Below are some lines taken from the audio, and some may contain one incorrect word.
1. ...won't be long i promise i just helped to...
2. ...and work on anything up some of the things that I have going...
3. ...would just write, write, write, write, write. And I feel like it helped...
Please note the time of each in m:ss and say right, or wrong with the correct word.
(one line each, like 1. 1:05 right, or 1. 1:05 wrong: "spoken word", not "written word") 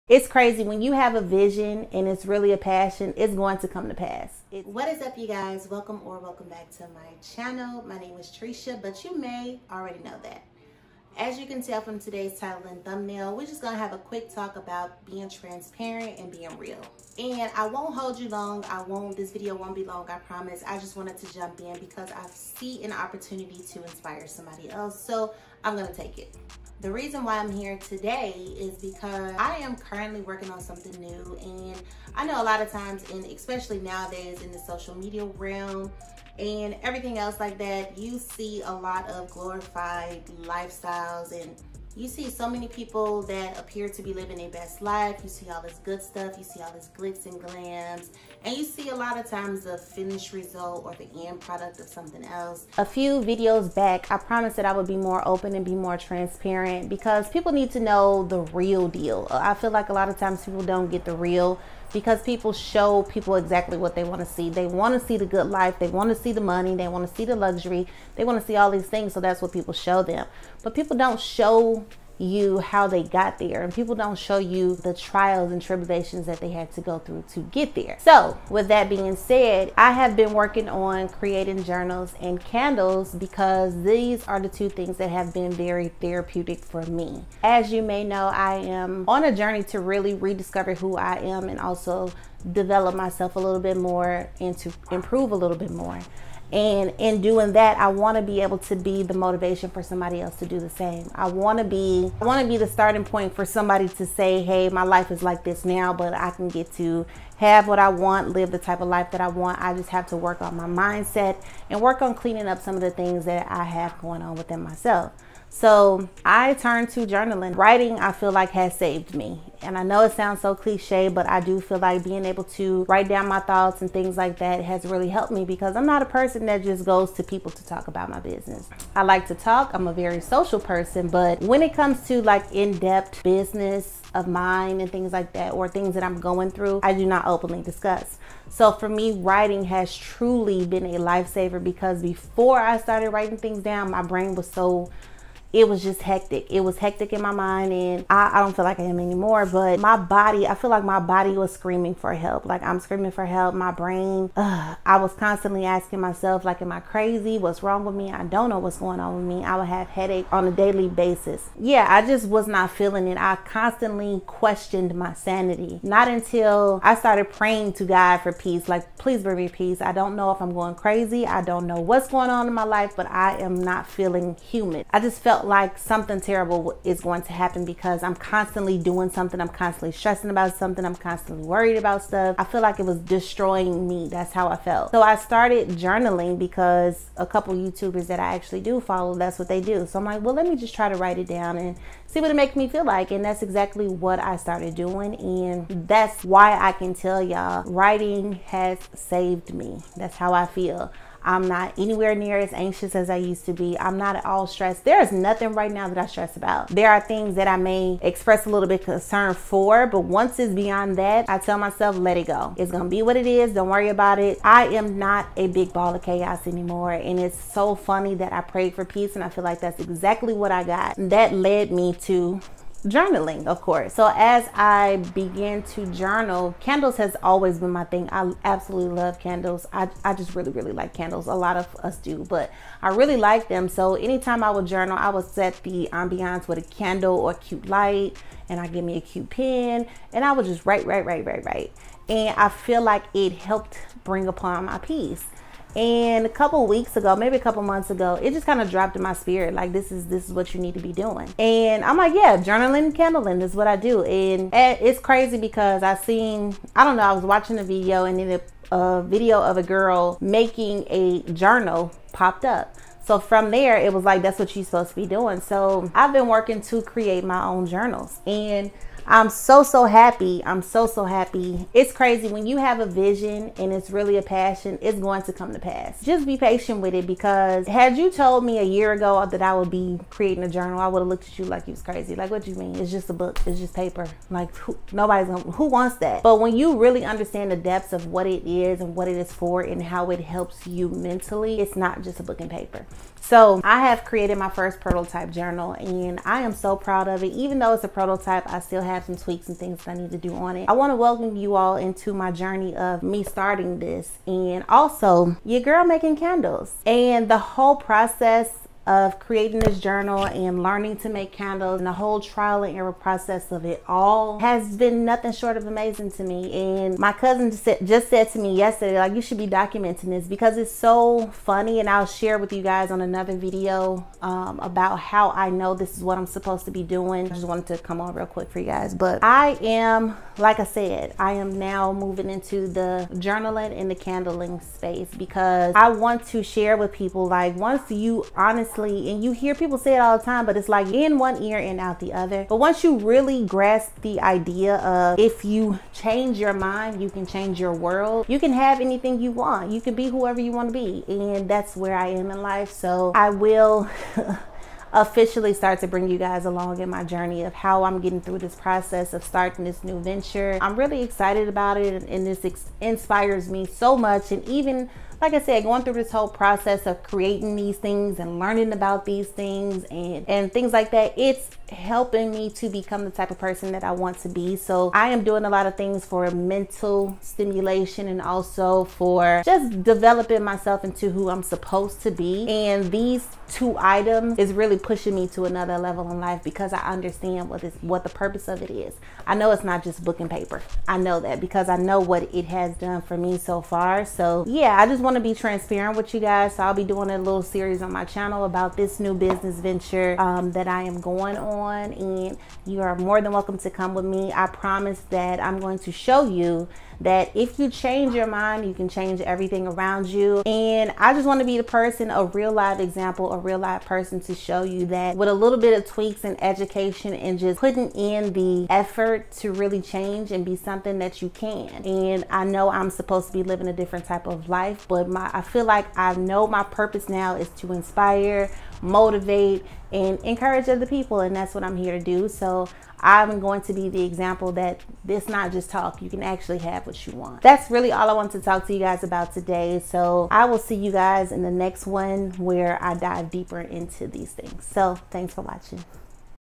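1. 0:19 wrong: "wanted", not "helped"
2. 1:51 wrong: "cleaning", not "anything"
3. 4:00 right.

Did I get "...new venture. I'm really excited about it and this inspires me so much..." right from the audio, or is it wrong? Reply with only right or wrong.
right.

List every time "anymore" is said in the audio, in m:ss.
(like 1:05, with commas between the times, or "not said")
2:28, 3:36.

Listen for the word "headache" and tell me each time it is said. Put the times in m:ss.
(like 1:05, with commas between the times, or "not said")
2:39.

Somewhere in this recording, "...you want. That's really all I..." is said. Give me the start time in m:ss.
7:17.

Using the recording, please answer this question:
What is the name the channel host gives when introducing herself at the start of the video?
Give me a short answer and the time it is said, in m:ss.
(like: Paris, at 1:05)
Triecia, at 0:08.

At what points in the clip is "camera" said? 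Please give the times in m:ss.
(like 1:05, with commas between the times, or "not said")
not said.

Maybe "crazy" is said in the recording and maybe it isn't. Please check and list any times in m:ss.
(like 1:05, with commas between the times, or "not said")
0:00, 2:36, 2:50, 4:14, 4:31, 4:41.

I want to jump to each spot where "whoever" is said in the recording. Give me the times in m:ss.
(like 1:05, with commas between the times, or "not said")
5:50.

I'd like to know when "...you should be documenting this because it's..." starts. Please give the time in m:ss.
5:19.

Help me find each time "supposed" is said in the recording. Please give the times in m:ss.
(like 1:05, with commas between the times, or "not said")
4:24, 5:26, 6:21, 7:02.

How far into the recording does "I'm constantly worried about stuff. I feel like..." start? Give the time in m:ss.
3:00.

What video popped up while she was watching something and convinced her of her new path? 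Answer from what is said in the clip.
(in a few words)
A girl making a journal.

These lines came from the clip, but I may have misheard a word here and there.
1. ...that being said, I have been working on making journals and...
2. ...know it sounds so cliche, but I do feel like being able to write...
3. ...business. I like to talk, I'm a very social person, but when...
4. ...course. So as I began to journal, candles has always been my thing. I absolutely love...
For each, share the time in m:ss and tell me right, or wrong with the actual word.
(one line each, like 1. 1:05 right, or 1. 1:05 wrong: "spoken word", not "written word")
1. 1:18 wrong: "creating", not "making"
2. 1:59 right
3. 2:08 right
4. 3:43 right.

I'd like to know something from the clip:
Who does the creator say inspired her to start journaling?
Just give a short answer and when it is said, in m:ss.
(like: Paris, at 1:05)
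A couple YouTubers, at 3:07.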